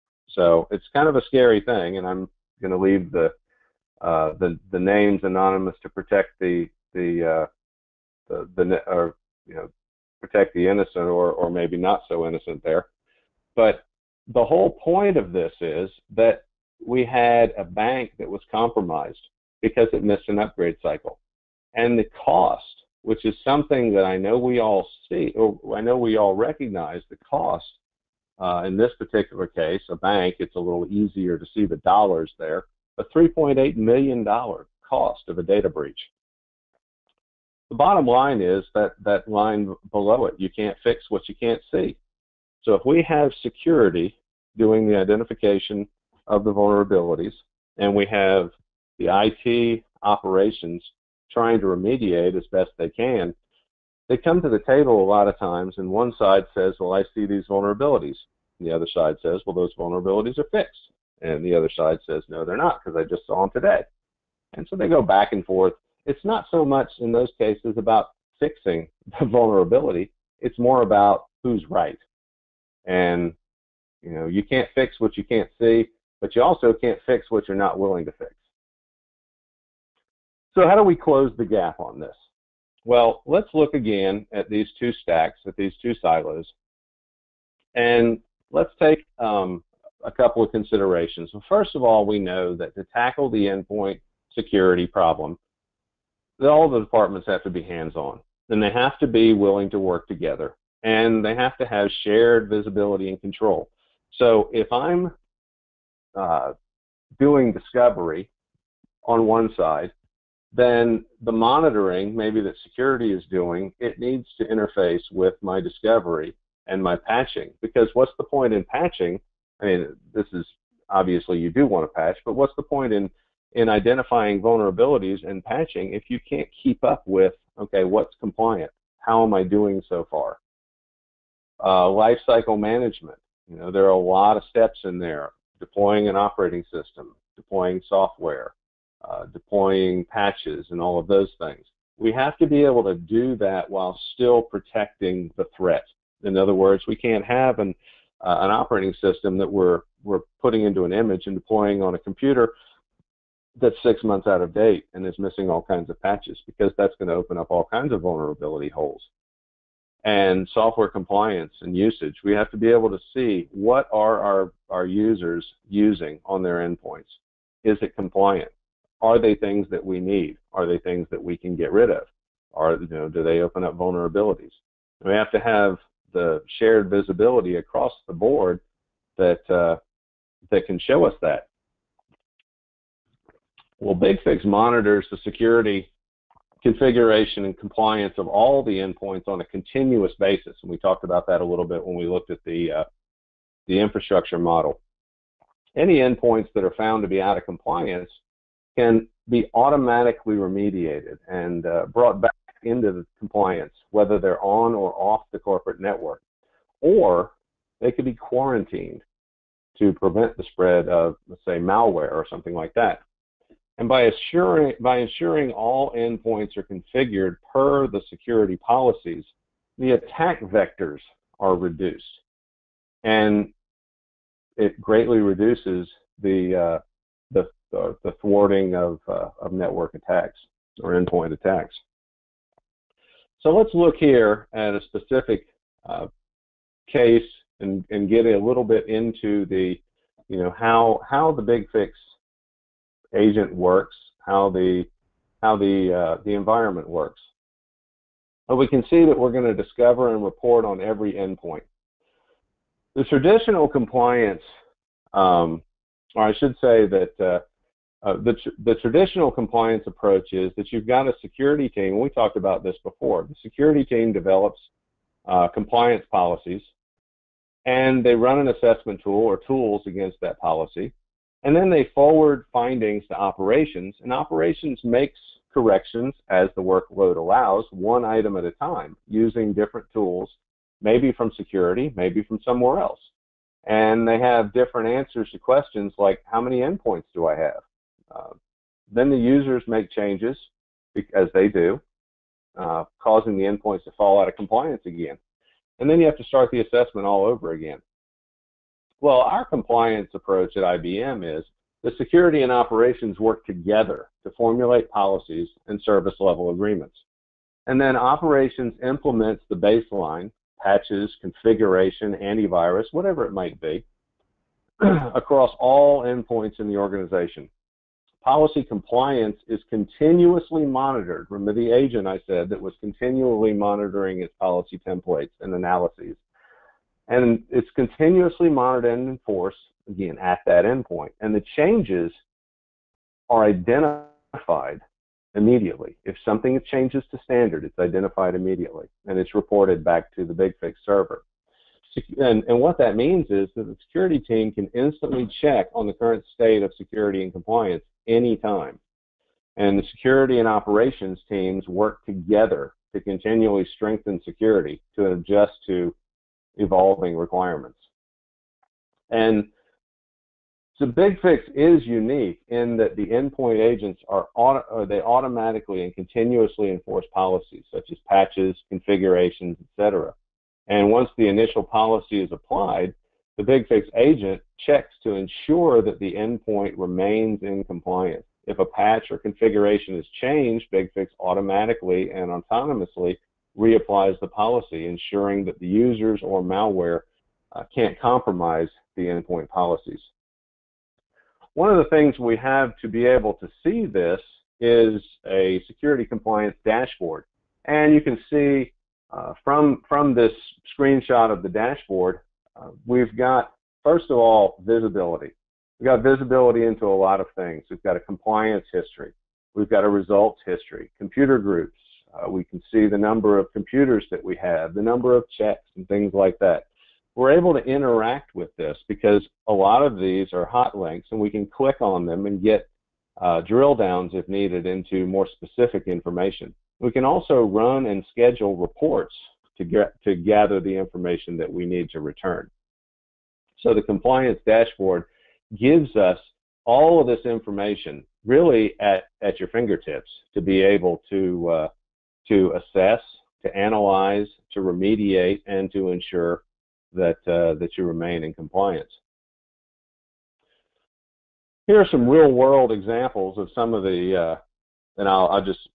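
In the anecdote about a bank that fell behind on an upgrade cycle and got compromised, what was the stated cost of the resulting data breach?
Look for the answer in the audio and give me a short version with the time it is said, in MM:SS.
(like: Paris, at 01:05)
$3.8 million, at 00:33.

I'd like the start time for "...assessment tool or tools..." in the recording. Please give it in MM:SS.
04:28.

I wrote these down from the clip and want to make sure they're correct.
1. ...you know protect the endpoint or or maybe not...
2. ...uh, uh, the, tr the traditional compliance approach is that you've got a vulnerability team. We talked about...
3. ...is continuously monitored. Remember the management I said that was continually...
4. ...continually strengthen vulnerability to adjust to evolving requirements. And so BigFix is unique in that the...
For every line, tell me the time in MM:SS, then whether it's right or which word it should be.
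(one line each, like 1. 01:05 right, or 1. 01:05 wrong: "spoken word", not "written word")
1. 00:09 wrong: "innocent", not "endpoint"
2. 04:17 wrong: "security", not "vulnerability"
3. 05:19 wrong: "agent", not "management"
4. 05:53 wrong: "security", not "vulnerability".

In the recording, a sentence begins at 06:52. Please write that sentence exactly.
Uh, we can see the number of computers that we have, the number of checks and things like that.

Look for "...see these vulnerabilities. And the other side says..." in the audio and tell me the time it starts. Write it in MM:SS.
00:57.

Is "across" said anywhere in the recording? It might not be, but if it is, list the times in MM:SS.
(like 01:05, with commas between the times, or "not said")
02:57, 05:14.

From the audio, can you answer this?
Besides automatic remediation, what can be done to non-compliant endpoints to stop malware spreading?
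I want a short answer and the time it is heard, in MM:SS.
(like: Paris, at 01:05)
quarantined, at 03:28.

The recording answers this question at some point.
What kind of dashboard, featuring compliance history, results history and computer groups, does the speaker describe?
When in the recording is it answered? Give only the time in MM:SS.
06:35.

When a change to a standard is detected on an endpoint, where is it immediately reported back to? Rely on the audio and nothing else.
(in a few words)
BigFix server.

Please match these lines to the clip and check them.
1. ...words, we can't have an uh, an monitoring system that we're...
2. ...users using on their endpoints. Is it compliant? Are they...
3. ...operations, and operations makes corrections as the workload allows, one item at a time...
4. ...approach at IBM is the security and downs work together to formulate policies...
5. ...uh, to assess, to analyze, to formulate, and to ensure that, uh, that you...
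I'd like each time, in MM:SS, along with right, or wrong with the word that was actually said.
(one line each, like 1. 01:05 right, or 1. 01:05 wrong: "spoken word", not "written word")
1. 02:26 wrong: "operating", not "monitoring"
2. 02:44 right
3. 04:33 right
4. 05:00 wrong: "operations", not "downs"
5. 07:21 wrong: "remediate", not "formulate".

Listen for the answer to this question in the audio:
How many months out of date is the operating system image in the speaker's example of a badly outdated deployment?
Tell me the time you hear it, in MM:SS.
02:33.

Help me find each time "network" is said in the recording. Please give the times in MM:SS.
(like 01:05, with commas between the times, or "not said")
03:25, 03:49.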